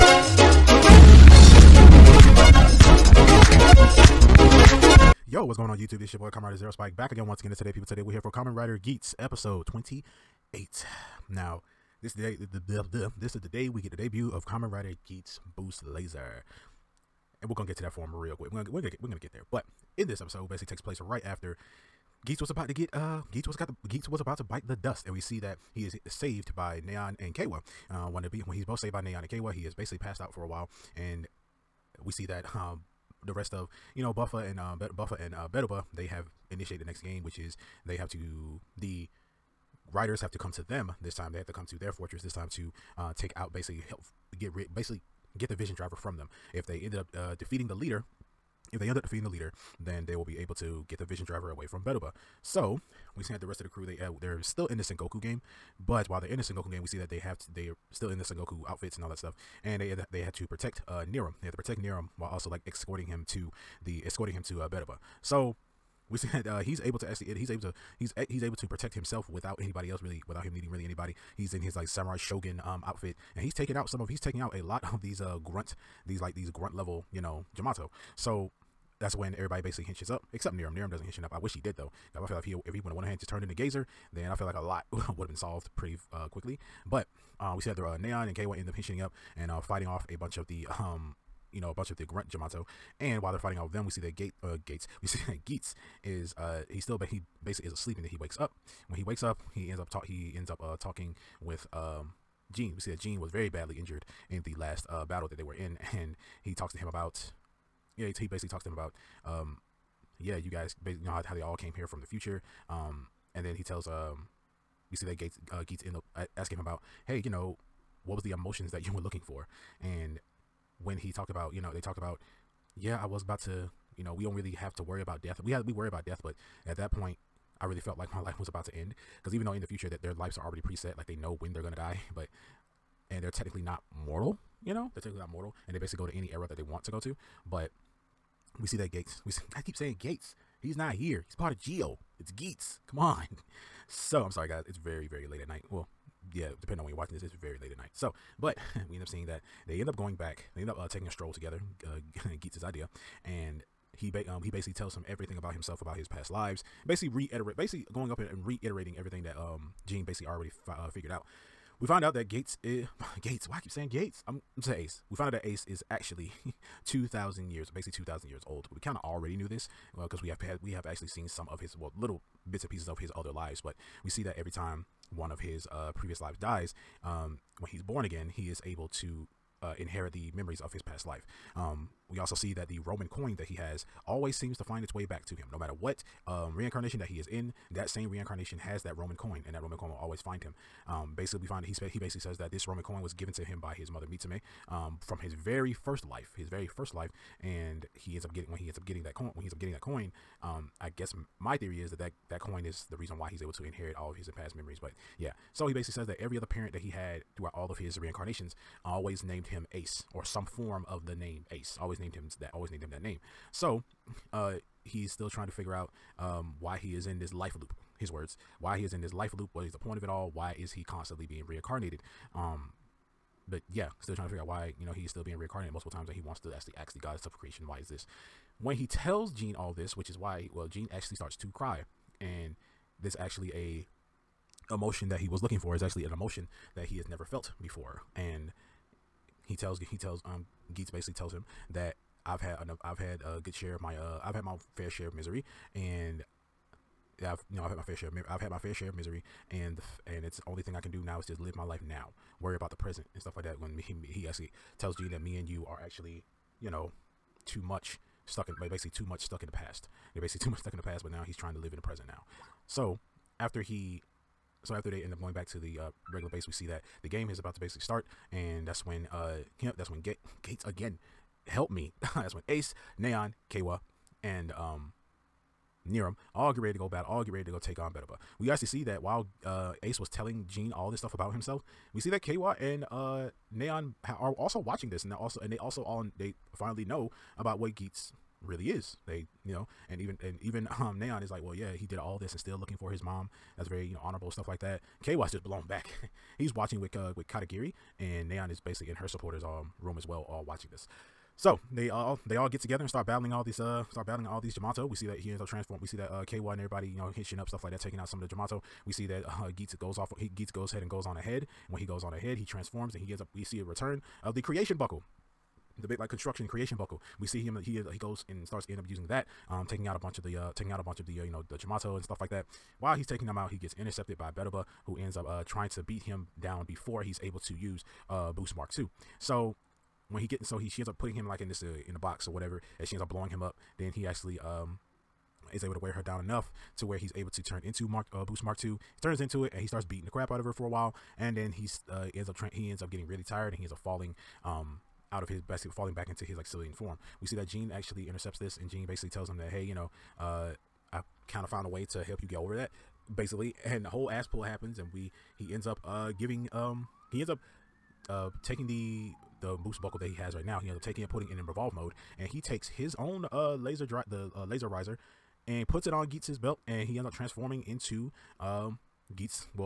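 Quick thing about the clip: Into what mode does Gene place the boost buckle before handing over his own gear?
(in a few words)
revolve mode.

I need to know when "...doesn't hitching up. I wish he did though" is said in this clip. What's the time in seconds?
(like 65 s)
80 s.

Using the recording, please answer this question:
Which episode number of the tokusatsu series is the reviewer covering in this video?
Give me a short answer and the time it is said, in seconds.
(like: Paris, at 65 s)
28, at 9 s.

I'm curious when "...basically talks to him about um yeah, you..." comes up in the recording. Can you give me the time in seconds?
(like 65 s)
108 s.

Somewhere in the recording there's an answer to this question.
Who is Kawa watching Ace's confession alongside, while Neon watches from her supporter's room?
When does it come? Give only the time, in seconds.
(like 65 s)
297 s.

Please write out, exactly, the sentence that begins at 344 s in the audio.
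Um, out of his best falling back into his like civilian form.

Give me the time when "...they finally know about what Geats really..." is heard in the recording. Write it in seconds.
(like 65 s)
286 s.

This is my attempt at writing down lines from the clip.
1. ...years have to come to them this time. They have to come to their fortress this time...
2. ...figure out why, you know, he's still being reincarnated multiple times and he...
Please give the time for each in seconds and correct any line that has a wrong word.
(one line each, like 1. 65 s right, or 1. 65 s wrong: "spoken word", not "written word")
1. 39 s wrong: "writers", not "years"
2. 224 s right.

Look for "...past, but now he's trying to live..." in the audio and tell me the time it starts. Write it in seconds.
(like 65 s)
260 s.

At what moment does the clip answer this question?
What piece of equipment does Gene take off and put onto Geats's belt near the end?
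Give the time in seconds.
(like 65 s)
364 s.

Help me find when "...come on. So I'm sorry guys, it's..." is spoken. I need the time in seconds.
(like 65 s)
142 s.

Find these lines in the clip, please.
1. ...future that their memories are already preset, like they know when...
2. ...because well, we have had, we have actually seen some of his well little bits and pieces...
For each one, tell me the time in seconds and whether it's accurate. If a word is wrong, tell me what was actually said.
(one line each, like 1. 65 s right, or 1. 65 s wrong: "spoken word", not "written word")
1. 129 s wrong: "lives", not "memories"
2. 169 s right.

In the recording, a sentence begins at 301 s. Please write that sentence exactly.
So they all they all get together and start battling all these uh start battling all these Jamato.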